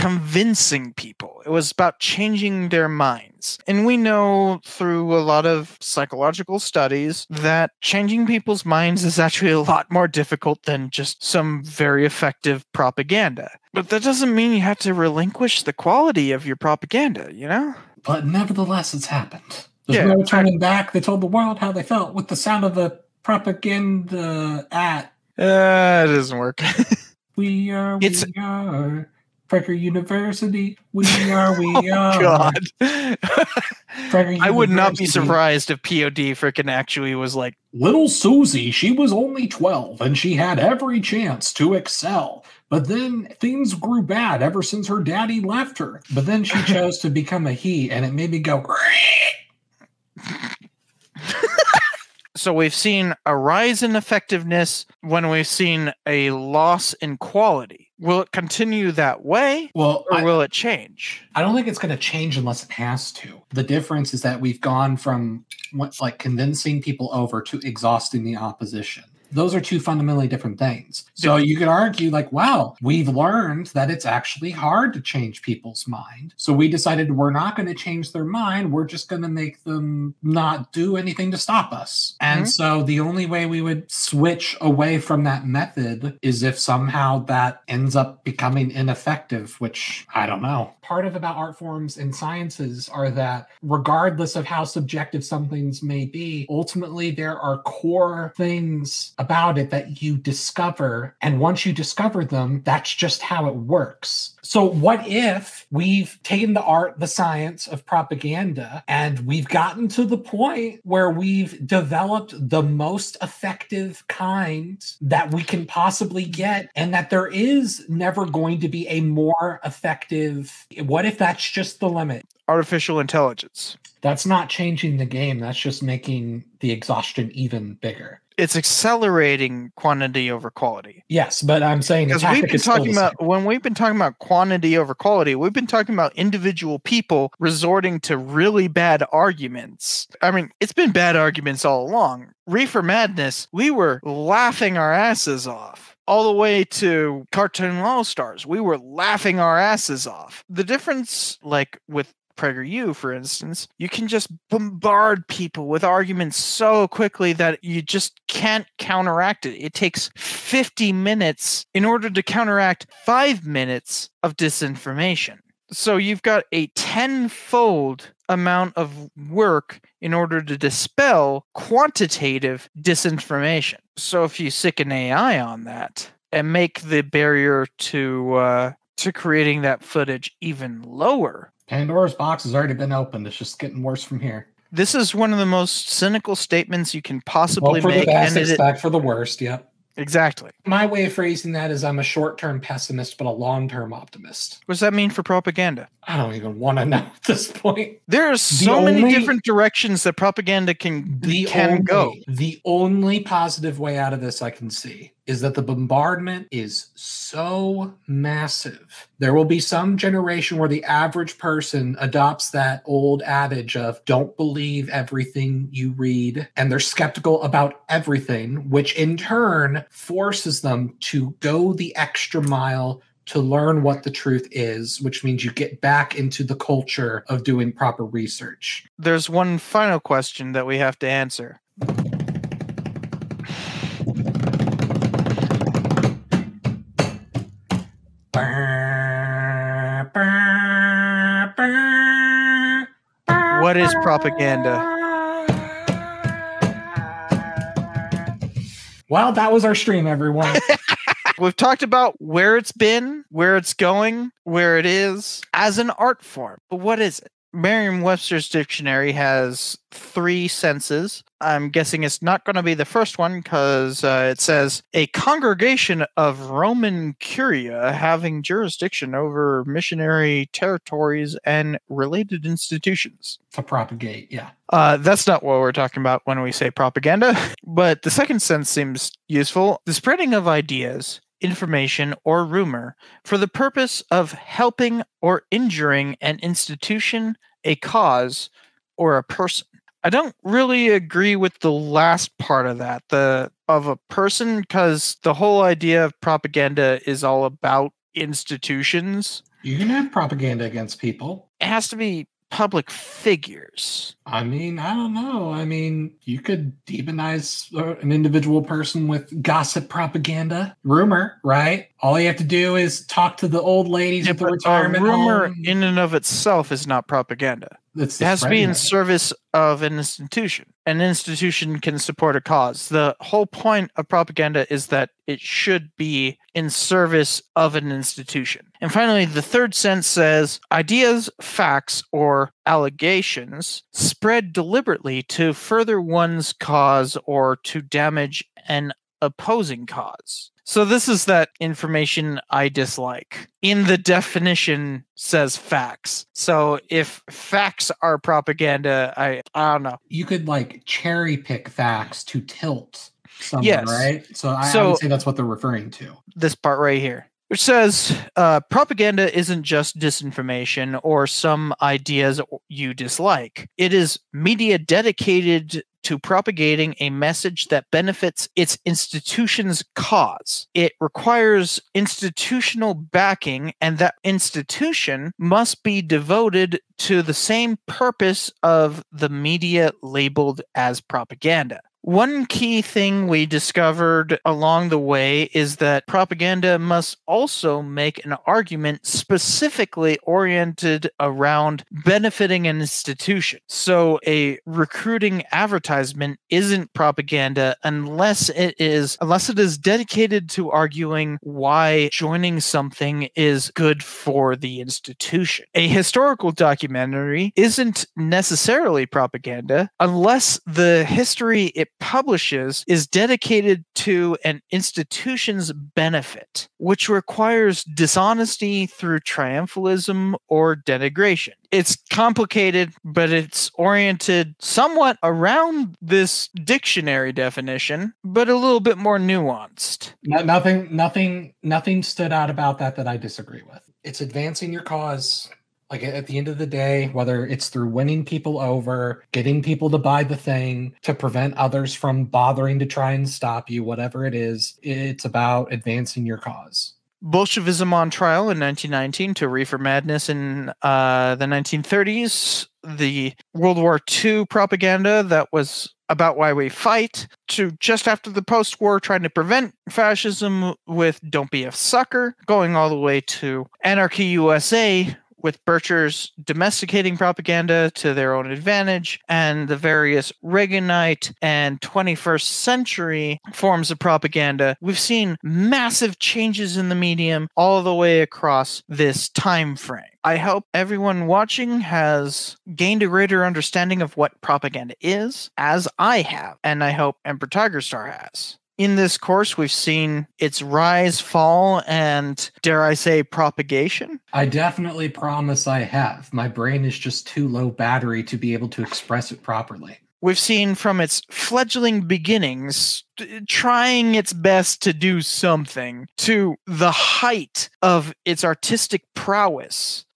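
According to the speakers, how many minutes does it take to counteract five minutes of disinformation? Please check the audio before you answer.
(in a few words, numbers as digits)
50.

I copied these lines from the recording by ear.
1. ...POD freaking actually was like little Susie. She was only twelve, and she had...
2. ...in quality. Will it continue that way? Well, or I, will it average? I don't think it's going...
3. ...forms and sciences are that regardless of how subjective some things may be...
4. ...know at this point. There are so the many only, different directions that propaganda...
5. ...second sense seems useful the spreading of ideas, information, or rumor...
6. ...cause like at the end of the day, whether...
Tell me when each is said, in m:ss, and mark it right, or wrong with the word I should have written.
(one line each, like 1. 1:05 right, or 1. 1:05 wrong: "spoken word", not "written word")
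1. 0:35 right
2. 0:56 wrong: "change", not "average"
3. 1:31 right
4. 3:16 right
5. 4:38 right
6. 7:14 right.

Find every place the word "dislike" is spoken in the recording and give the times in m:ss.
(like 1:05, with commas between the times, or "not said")
5:42, 6:02.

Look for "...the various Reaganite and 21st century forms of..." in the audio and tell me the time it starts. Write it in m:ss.
7:49.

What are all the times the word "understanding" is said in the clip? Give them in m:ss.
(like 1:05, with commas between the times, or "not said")
8:03.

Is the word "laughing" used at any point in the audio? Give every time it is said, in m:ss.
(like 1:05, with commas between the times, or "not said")
2:24, 2:28.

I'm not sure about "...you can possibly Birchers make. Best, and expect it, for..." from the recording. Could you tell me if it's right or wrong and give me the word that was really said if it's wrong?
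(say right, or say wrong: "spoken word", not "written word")
wrong: "For", not "Birchers".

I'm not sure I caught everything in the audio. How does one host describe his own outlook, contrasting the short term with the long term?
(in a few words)
short term pessimist.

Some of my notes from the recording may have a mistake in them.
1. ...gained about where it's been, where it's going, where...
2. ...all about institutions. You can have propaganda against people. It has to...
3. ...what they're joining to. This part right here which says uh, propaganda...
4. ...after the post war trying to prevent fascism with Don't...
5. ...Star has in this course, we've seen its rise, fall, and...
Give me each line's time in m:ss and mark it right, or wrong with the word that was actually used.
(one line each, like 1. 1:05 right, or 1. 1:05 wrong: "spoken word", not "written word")
1. 4:11 wrong: "talked", not "gained"
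2. 4:57 right
3. 5:55 wrong: "referring", not "joining"
4. 7:38 right
5. 8:07 right.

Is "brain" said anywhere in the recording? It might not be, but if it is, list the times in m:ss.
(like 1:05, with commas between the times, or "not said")
8:16.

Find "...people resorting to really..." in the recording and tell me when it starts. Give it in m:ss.
2:16.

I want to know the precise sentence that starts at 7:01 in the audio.
It's complicated, but it's oriented somewhat around this dictionary definition, but a little bit more nuanced.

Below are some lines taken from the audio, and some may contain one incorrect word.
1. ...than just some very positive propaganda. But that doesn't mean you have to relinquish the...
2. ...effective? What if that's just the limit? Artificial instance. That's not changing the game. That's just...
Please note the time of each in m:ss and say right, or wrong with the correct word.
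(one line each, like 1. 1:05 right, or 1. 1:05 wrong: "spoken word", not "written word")
1. 0:10 wrong: "effective", not "positive"
2. 1:59 wrong: "intelligence", not "instance".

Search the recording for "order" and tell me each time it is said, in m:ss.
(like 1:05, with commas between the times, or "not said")
2:41, 2:50.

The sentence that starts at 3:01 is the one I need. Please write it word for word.
Pandora's box has already been opened.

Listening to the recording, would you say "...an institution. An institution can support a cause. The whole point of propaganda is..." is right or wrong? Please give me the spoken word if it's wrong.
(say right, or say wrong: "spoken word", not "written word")
right.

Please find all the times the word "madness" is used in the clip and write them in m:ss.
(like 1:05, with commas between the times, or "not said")
2:22, 7:29.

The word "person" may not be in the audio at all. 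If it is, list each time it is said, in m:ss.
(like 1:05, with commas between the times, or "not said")
3:31, 4:49, 4:54, 5:08.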